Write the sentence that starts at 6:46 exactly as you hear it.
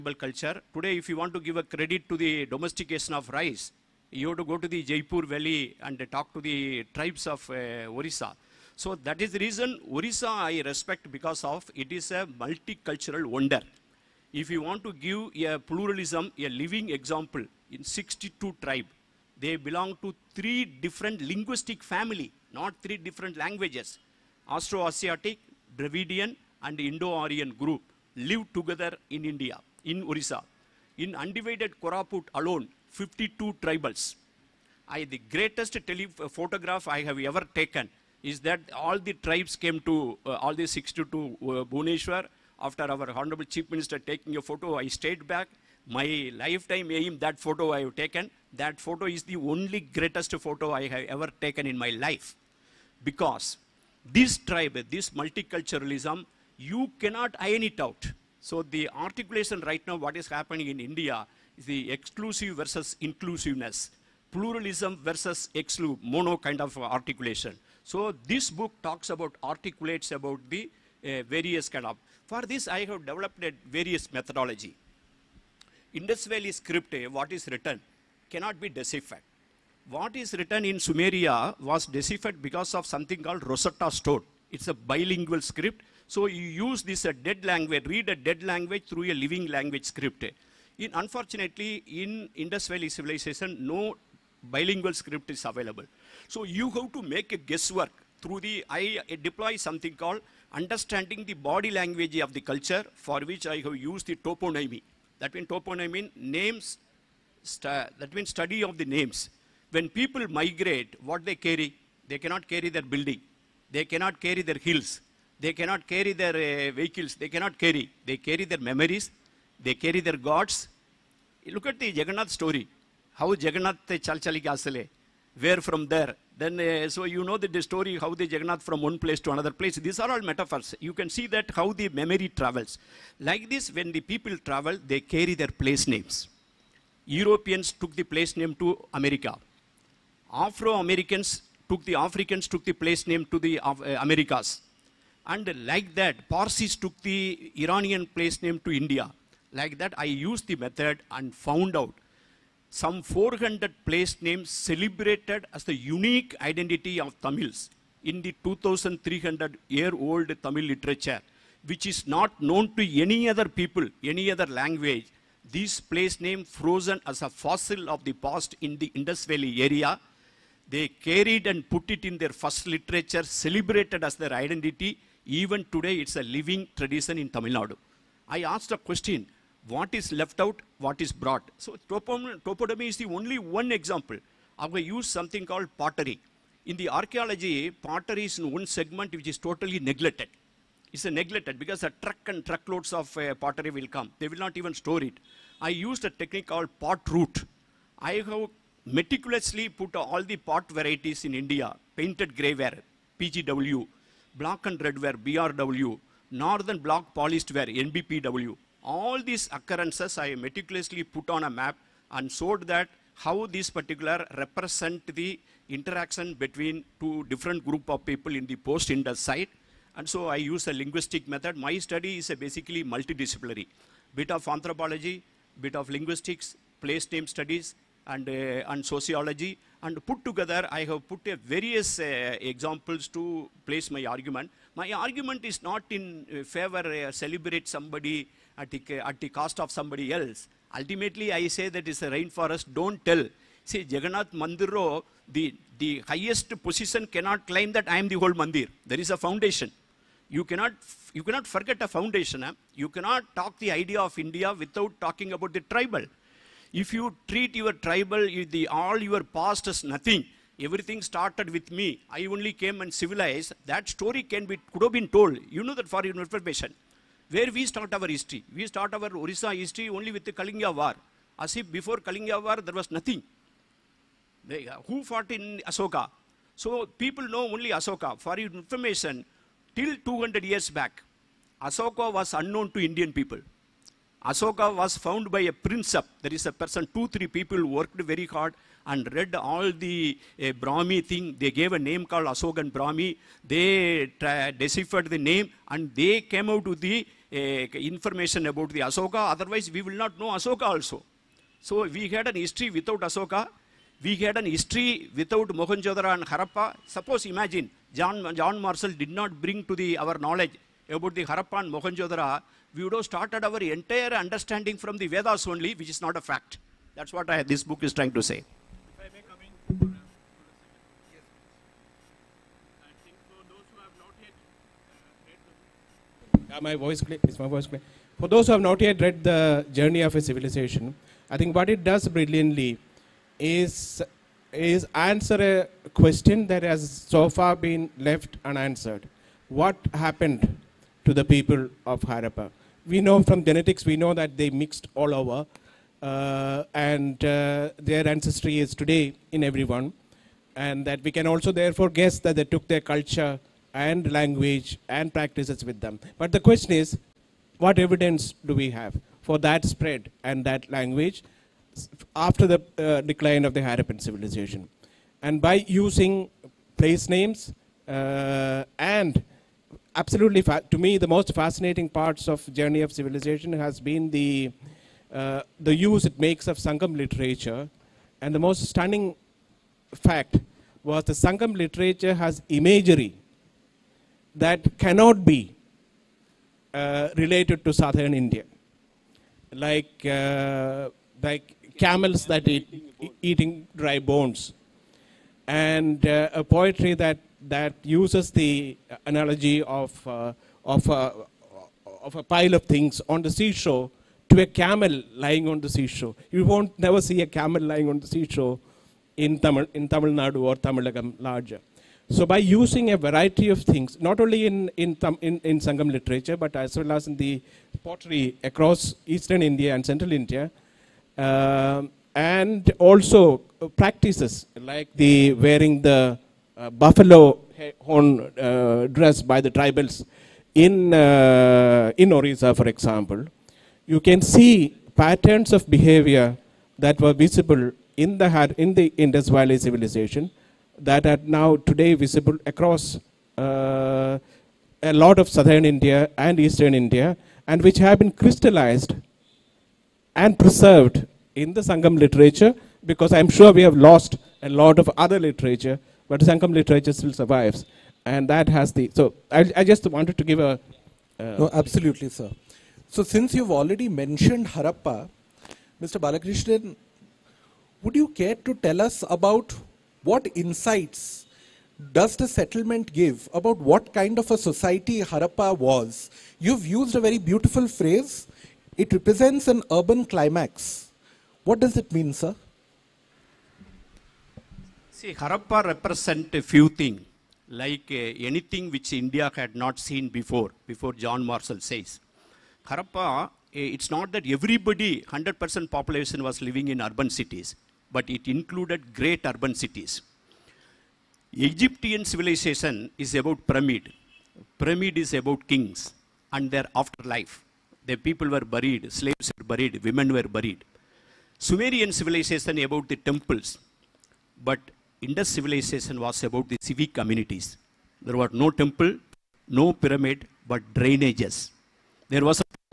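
You won't never see a camel lying on the seashore in Tamil, in Tamil Nadu or Tamilagam larger.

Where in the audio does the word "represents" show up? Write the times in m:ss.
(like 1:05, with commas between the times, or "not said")
3:34, 7:58, 8:05.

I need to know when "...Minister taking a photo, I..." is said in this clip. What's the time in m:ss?
0:43.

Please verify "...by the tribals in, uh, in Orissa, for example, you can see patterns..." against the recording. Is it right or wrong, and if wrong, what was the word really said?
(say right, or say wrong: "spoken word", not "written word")
right.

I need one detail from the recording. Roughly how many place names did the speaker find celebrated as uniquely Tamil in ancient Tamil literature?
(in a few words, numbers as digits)
400.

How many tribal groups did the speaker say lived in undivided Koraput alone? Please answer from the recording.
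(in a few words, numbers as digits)
52.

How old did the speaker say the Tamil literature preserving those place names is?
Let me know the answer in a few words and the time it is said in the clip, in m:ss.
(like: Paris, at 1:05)
2300 years, at 2:38.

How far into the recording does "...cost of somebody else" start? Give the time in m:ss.
3:59.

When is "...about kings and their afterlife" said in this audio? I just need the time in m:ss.
8:25.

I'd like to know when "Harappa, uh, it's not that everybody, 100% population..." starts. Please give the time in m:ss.
8:12.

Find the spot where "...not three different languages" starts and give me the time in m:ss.
0:22.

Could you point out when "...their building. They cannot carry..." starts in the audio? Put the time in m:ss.
1:52.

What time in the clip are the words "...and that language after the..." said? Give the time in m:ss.
6:00.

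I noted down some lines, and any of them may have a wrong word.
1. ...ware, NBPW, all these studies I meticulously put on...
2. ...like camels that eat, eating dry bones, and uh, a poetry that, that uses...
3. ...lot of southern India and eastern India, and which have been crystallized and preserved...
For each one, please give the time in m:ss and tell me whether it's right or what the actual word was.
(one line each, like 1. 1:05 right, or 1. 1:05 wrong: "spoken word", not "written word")
1. 3:27 wrong: "occurrences", not "studies"
2. 6:31 right
3. 7:24 right.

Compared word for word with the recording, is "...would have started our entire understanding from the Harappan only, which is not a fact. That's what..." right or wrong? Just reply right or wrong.
wrong.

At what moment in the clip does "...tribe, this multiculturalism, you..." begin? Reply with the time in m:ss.
0:54.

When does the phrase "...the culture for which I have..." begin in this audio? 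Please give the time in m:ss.
1:42.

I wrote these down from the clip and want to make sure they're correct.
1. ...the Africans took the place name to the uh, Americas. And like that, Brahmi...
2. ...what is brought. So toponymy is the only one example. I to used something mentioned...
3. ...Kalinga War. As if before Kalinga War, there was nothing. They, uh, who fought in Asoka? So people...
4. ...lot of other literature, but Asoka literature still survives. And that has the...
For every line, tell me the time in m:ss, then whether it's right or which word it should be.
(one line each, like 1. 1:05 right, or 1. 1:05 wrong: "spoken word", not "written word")
1. 2:21 wrong: "Parsis", not "Brahmi"
2. 3:00 wrong: "called", not "mentioned"
3. 4:30 right
4. 7:34 wrong: "Sangam", not "Asoka".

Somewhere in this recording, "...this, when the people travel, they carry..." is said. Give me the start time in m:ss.
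2:13.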